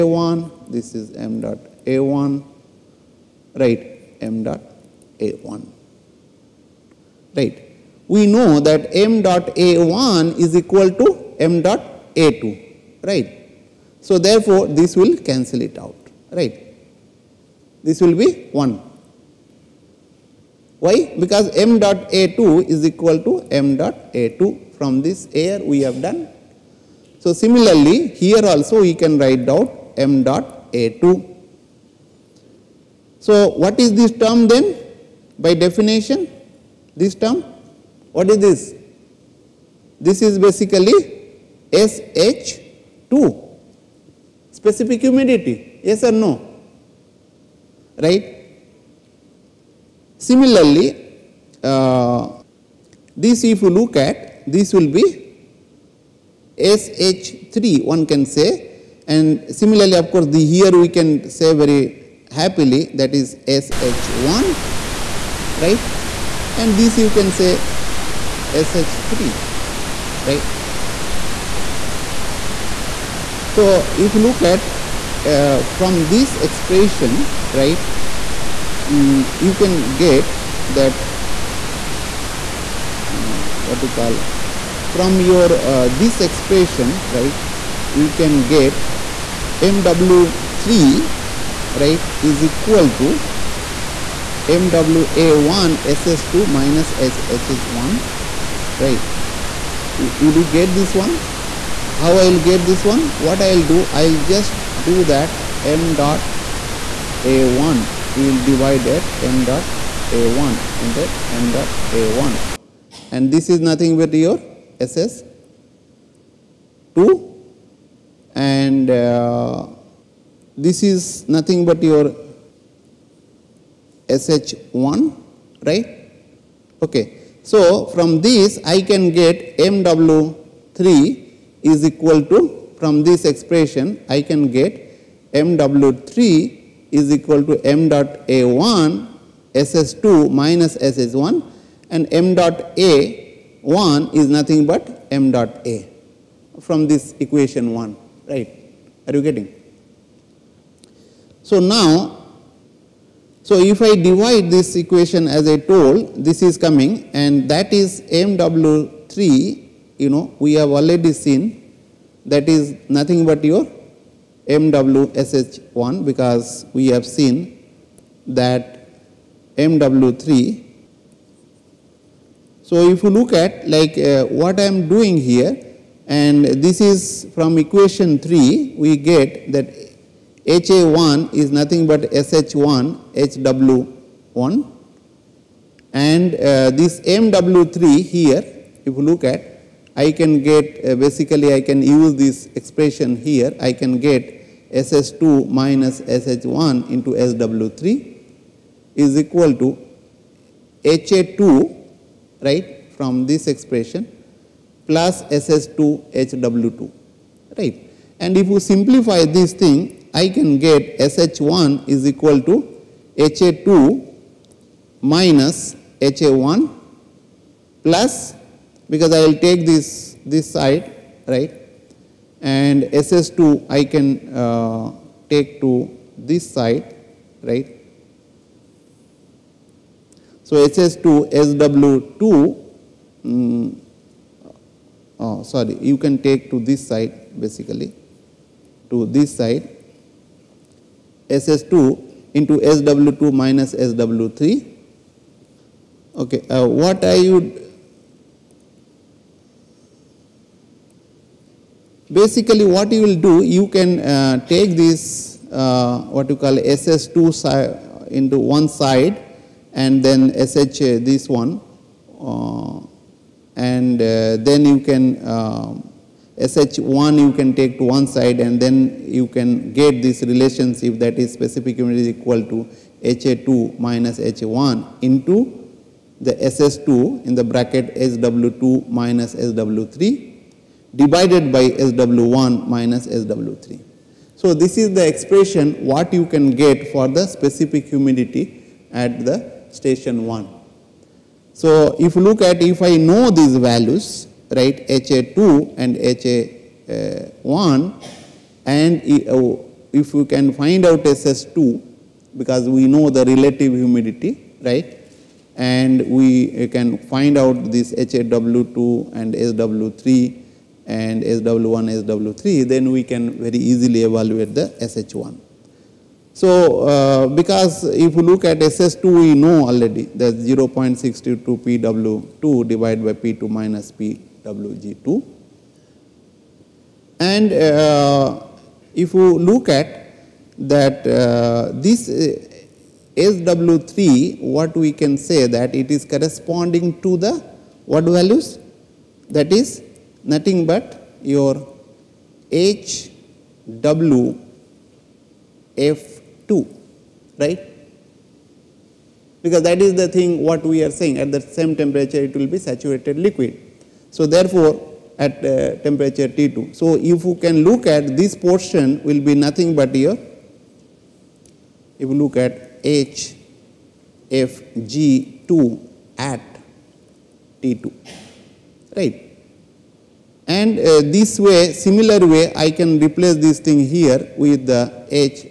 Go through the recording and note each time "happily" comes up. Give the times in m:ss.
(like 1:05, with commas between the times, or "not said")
1:02.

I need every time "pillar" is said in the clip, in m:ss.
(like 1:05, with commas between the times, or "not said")
not said.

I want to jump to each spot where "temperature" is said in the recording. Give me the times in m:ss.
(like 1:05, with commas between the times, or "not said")
5:51, 5:55.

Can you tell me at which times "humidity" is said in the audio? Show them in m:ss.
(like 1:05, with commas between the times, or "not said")
0:45, 4:47, 5:03.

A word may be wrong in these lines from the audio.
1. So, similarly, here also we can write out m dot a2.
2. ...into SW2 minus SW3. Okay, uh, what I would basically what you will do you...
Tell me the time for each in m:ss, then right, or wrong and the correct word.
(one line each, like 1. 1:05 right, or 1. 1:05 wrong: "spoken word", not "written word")
1. 0:27 right
2. 4:02 right.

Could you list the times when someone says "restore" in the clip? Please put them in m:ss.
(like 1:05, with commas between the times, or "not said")
not said.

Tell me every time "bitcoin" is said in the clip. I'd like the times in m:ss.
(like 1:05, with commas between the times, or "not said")
not said.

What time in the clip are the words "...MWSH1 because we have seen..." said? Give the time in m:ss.
2:44.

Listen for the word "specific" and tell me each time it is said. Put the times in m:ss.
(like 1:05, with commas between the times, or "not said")
0:44, 4:31, 4:47.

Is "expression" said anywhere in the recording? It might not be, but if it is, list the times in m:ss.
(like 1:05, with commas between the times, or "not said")
1:16, 1:26, 2:13, 3:12, 3:23, 4:45.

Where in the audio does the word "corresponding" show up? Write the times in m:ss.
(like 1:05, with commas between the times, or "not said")
5:36.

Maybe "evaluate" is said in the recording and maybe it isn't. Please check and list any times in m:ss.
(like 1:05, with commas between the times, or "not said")
5:14.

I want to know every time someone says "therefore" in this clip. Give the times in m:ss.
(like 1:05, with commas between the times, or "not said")
0:14, 5:54.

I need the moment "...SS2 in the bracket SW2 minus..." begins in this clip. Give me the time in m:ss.
4:36.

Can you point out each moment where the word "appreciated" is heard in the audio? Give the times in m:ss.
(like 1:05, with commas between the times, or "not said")
not said.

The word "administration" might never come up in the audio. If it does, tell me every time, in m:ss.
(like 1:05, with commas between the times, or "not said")
not said.